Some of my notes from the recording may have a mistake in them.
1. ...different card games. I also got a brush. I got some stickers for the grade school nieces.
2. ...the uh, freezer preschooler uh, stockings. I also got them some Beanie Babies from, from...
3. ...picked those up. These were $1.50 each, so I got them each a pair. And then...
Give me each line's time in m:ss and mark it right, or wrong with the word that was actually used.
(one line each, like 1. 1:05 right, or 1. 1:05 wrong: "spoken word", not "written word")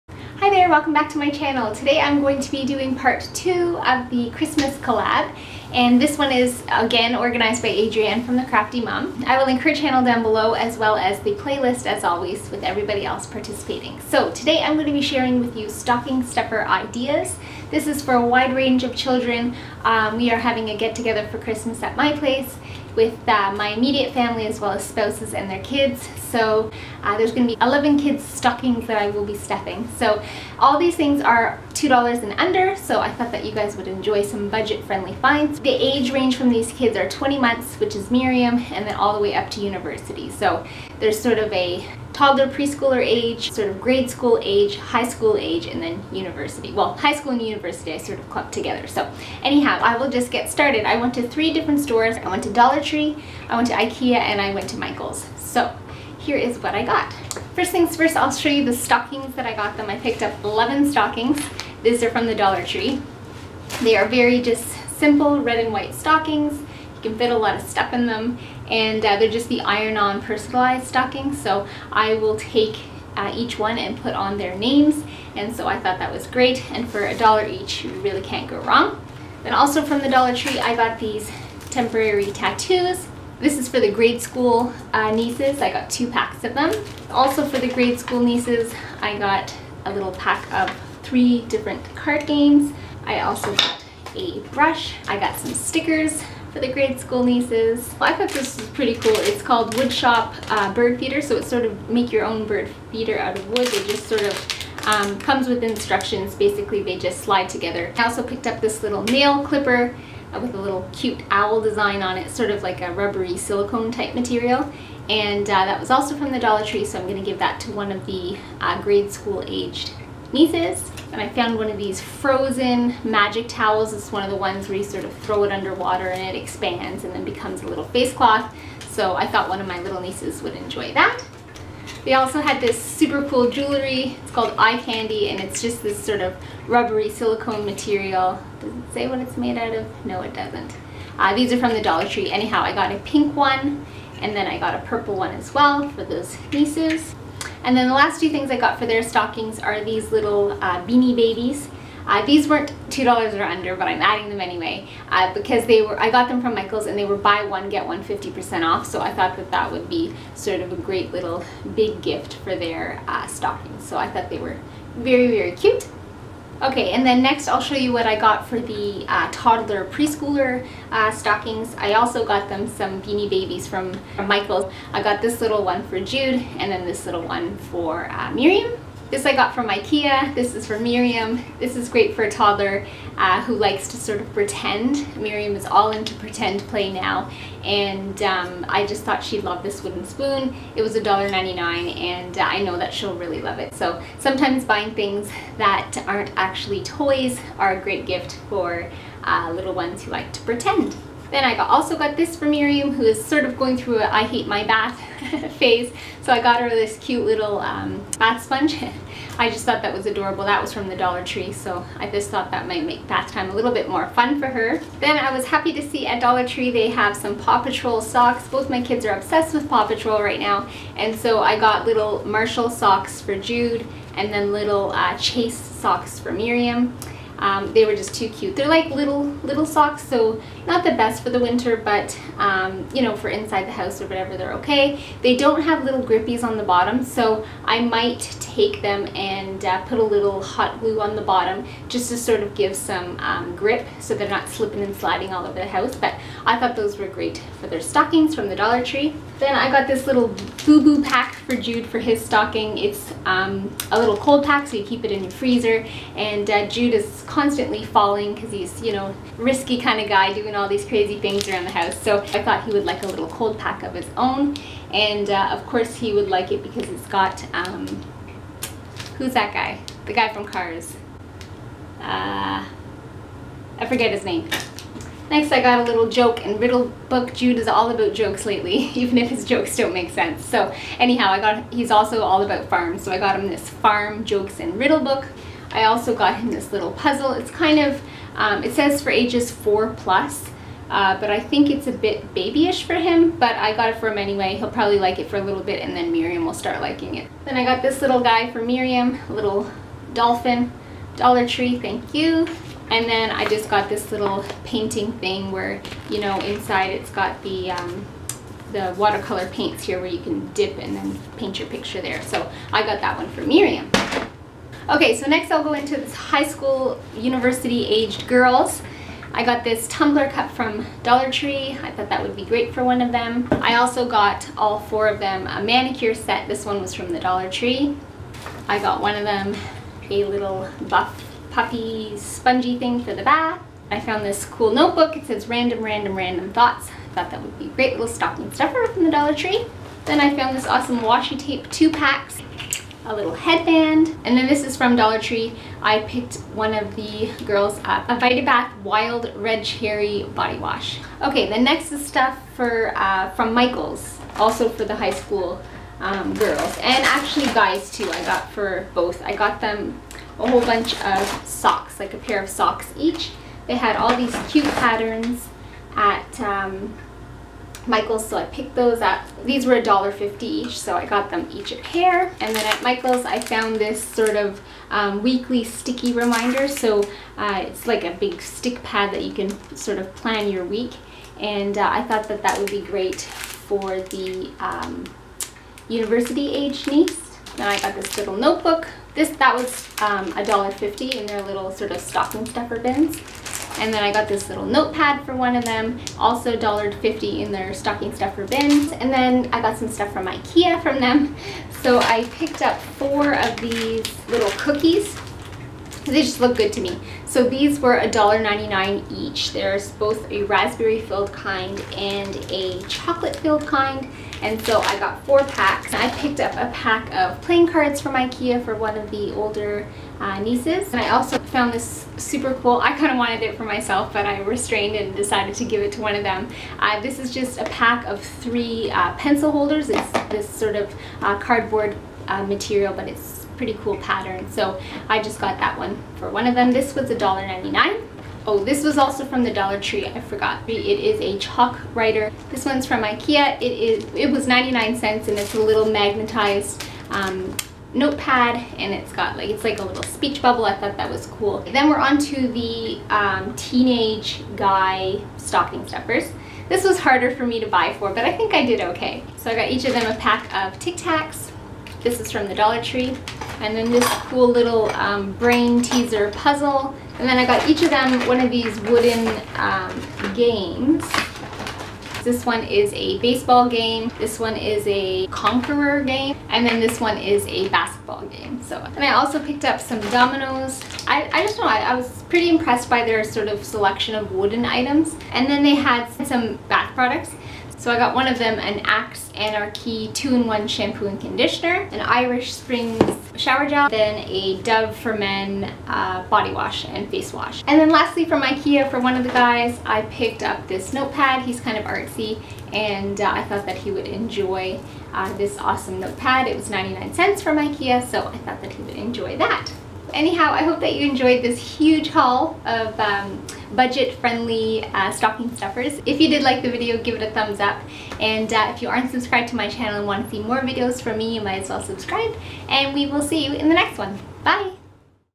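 1. 1:31 right
2. 2:48 wrong: "toddler", not "freezer"
3. 6:08 right.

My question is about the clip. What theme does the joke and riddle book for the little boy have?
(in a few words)
Farm.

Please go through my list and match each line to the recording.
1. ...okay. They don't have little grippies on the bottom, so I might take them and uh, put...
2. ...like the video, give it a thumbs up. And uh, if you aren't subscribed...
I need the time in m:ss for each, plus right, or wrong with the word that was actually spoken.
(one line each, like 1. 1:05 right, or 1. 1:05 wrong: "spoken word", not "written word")
1. 3:54 right
2. 8:36 right.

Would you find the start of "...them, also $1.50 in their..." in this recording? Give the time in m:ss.
6:35.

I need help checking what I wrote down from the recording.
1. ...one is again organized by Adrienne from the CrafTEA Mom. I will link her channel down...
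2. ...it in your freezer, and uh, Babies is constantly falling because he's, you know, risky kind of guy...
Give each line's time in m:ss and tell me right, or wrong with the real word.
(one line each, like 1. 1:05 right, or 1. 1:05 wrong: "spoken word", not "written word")
1. 0:06 right
2. 4:15 wrong: "Jude", not "Babies".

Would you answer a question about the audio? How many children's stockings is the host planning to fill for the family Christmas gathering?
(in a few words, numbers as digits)
11.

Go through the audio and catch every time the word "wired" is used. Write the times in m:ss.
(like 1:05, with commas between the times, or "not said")
not said.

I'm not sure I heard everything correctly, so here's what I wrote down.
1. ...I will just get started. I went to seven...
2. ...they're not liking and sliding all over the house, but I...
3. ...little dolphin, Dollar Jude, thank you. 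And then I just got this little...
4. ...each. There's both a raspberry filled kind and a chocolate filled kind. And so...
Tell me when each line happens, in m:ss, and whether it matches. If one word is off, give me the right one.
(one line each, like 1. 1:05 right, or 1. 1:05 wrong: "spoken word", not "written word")
1. 0:49 wrong: "three", not "seven"
2. 4:04 wrong: "slipping", not "liking"
3. 4:59 wrong: "Tree", not "Jude"
4. 6:49 right.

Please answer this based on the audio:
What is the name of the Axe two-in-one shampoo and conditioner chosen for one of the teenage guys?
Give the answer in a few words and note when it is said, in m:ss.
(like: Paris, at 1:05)
Anarchy, at 8:08.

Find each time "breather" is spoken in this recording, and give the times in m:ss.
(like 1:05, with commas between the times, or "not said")
not said.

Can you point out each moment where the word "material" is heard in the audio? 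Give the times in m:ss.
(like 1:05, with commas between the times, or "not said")
1:54, 2:17, 7:12.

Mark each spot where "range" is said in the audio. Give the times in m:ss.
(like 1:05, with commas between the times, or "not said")
0:18, 0:36.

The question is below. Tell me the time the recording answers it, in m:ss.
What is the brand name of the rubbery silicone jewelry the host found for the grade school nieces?
2:14.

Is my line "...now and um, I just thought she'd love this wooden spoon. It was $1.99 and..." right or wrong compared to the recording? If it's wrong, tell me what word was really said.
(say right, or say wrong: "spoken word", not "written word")
right.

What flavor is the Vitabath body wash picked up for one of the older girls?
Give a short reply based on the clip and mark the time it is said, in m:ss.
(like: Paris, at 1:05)
Wild Red Cherry, at 5:48.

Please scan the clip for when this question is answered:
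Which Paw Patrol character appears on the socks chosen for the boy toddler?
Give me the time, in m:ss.
3:42.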